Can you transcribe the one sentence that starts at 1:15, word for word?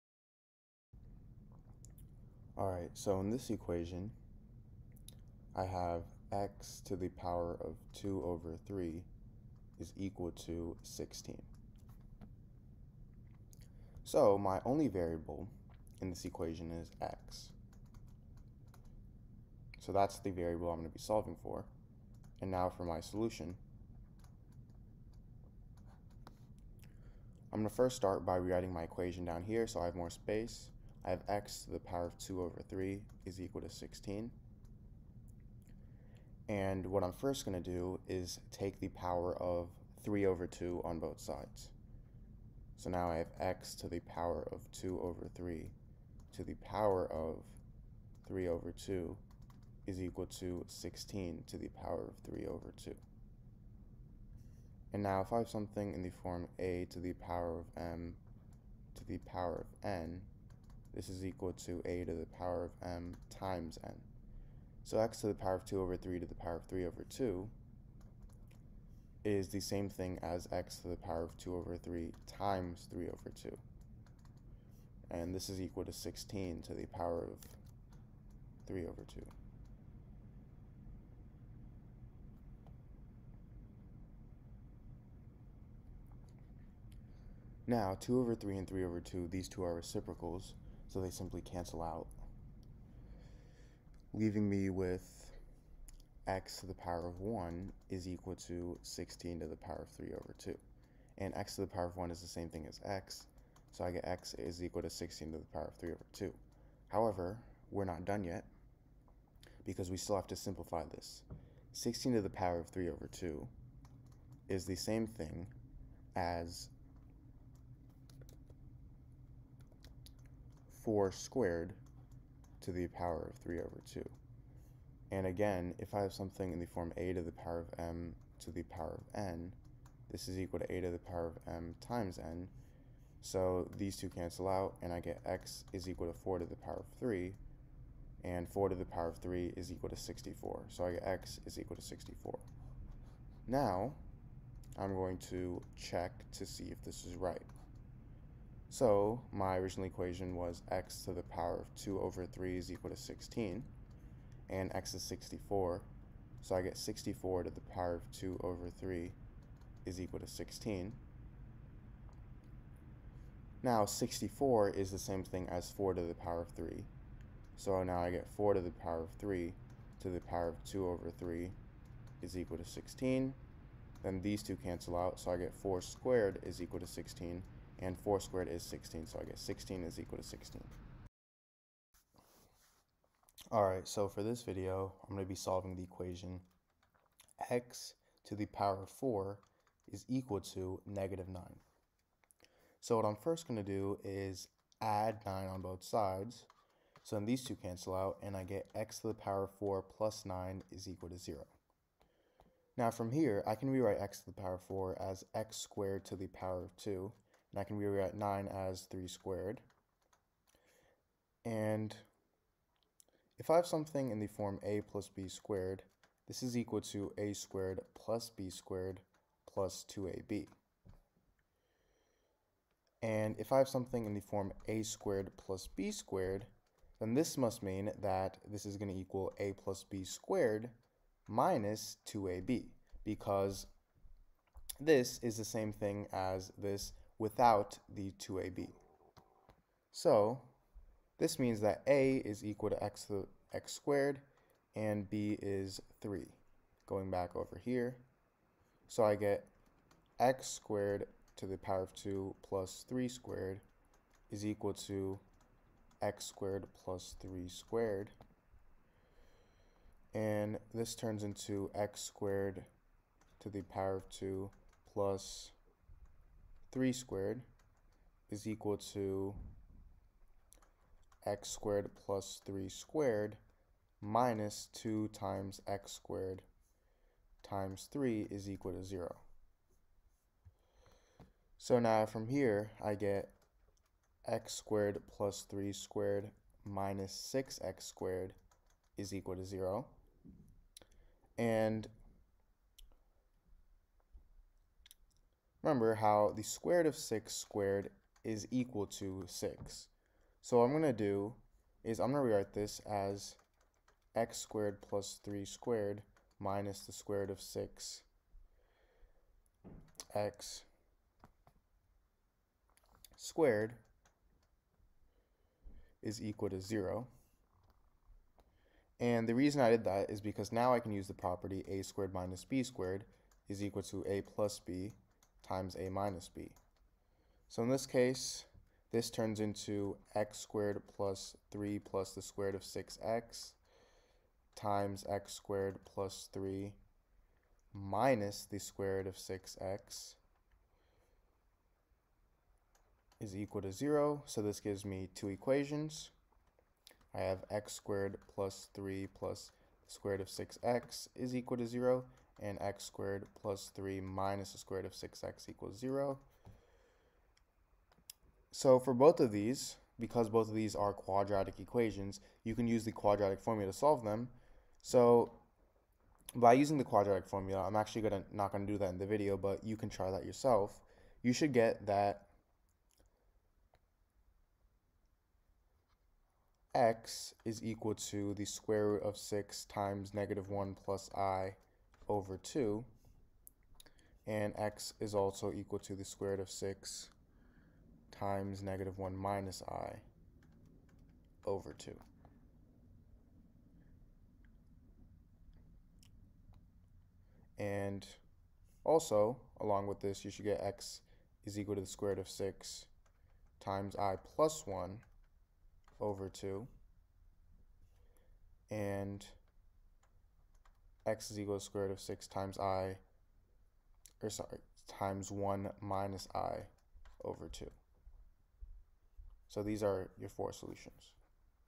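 And this is equal to 16 to the power of 3 over 2.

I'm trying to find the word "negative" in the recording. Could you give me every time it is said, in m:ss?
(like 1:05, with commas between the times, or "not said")
3:10, 6:20, 6:28.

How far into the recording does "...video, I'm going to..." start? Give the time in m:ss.
3:04.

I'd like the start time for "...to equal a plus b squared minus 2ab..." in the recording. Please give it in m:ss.
3:48.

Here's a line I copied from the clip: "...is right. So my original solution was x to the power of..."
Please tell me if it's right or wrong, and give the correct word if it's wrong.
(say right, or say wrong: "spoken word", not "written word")
wrong: "equation", not "solution".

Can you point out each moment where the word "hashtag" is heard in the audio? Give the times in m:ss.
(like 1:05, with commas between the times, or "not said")
not said.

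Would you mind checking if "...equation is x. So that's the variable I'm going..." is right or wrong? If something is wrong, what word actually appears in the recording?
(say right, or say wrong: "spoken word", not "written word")
right.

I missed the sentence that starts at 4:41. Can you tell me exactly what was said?
So now from here, I get x squared plus 3 squared minus 6x squared is equal to 0.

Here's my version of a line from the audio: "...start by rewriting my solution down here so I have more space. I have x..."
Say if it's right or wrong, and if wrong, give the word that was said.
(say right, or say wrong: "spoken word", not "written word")
wrong: "equation", not "solution".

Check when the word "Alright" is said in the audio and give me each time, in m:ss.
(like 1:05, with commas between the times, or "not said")
3:03.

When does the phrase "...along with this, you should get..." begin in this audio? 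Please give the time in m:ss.
6:39.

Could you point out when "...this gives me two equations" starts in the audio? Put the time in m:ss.
5:44.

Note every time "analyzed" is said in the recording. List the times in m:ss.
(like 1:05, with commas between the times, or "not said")
not said.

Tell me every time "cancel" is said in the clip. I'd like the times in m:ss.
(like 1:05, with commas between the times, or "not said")
1:31, 2:14, 2:54, 3:17.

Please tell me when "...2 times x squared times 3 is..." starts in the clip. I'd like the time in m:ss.
4:34.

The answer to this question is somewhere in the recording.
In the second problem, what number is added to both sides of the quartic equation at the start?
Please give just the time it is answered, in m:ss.
3:14.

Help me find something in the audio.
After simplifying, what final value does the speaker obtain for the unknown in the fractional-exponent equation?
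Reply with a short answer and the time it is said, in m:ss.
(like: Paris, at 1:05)
64, at 2:21.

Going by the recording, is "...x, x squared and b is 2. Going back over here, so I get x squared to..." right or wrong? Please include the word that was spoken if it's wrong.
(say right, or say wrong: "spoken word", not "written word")
wrong: "3", not "2".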